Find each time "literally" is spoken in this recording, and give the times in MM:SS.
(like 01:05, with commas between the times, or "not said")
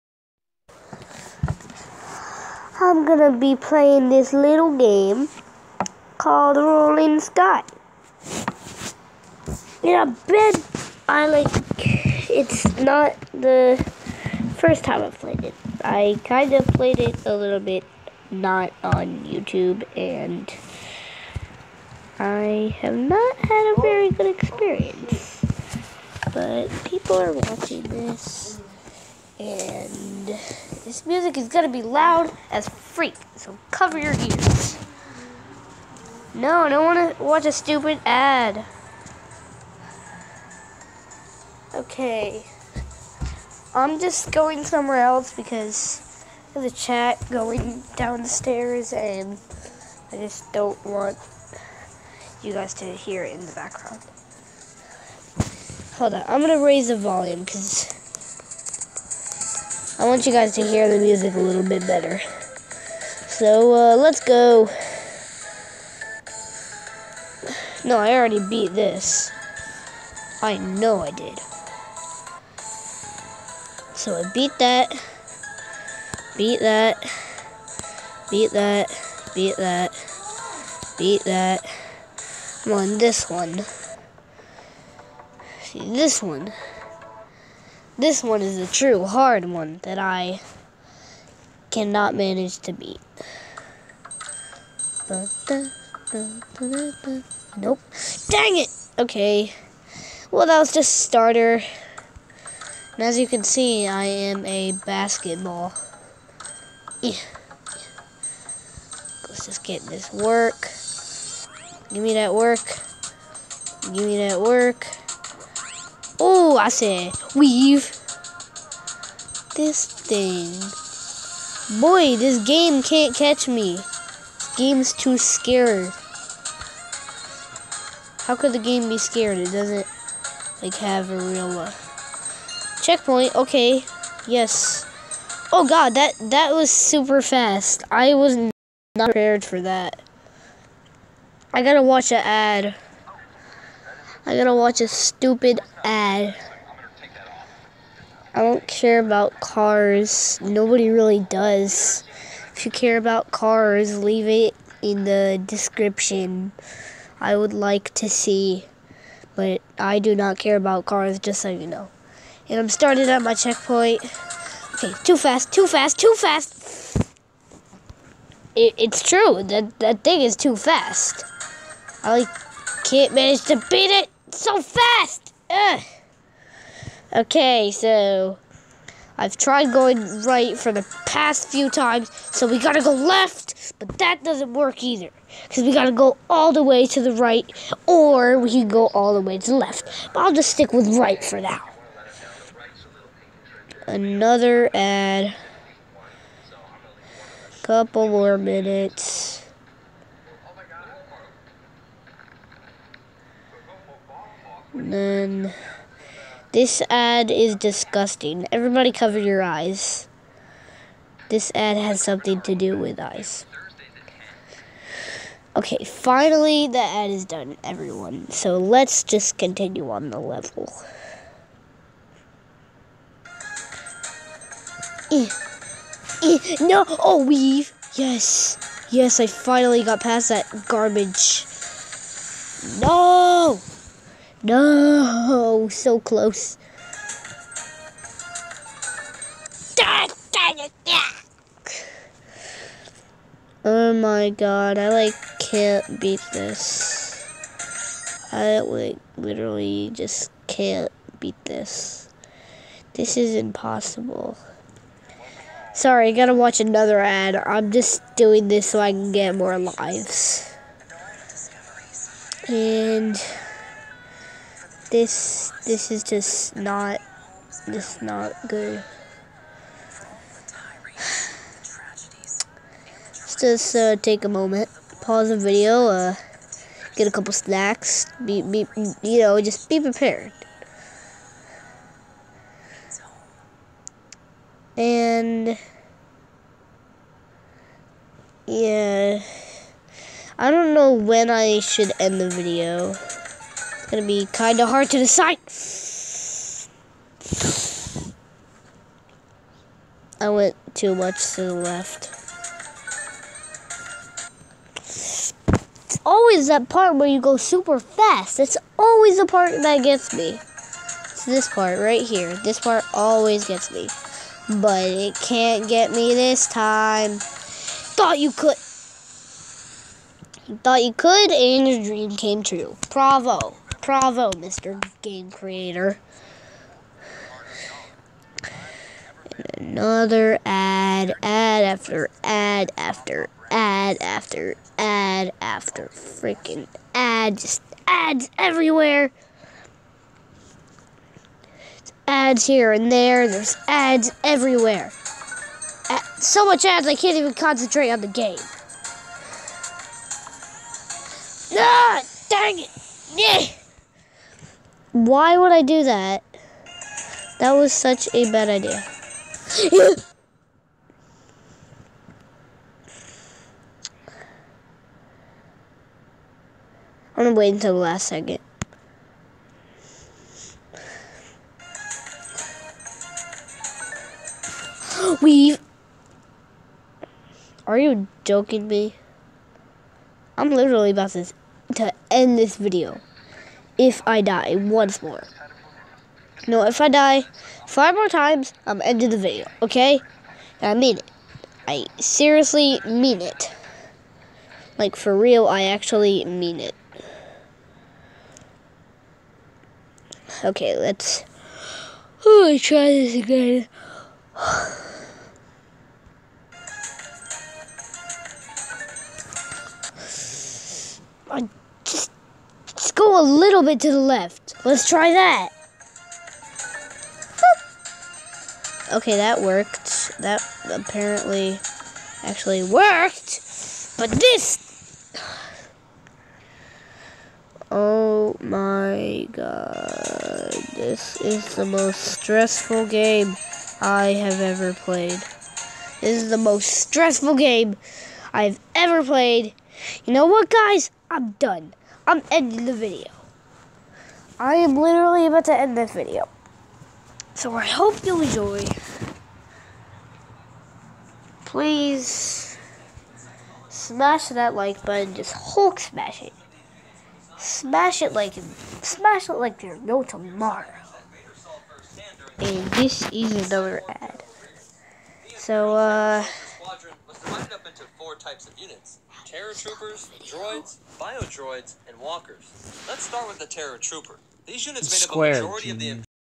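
04:09, 06:20, 07:24.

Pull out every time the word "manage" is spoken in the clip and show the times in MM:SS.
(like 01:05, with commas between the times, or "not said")
01:32, 02:53.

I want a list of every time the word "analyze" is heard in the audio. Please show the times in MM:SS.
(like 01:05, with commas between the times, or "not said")
not said.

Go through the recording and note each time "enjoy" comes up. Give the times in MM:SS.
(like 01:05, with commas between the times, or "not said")
07:28.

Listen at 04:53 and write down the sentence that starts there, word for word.
Gonna be kinda hard to decide.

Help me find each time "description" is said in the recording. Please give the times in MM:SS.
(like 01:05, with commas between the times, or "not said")
02:35.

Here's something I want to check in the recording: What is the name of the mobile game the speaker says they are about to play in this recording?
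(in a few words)
Rolling Sky.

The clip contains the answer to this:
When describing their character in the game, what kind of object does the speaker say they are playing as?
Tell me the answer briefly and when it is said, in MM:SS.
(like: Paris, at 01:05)
A basketball, at 01:44.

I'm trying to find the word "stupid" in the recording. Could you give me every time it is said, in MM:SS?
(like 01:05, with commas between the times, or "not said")
00:37, 02:24.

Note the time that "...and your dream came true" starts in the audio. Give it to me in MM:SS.
05:21.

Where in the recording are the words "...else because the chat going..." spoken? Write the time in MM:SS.
00:45.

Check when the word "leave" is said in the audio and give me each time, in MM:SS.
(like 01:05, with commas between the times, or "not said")
02:34.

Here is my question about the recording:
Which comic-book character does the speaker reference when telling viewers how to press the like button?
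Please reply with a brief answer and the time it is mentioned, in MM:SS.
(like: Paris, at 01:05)
Hulk, at 07:35.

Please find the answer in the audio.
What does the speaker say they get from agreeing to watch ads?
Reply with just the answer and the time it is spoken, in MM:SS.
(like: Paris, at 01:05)
More lives, at 04:19.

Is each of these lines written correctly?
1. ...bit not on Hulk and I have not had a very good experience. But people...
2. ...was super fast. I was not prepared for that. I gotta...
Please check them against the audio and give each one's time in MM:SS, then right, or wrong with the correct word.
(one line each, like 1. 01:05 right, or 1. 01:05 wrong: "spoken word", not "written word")
1. 00:17 wrong: "YouTube", not "Hulk"
2. 02:16 right.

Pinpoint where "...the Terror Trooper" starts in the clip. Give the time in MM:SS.
07:53.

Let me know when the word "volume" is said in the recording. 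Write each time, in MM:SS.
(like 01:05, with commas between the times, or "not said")
00:56.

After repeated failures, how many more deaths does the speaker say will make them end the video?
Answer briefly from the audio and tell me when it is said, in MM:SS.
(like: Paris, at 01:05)
5, at 06:27.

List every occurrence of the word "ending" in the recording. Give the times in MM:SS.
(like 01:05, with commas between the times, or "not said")
06:28, 07:22.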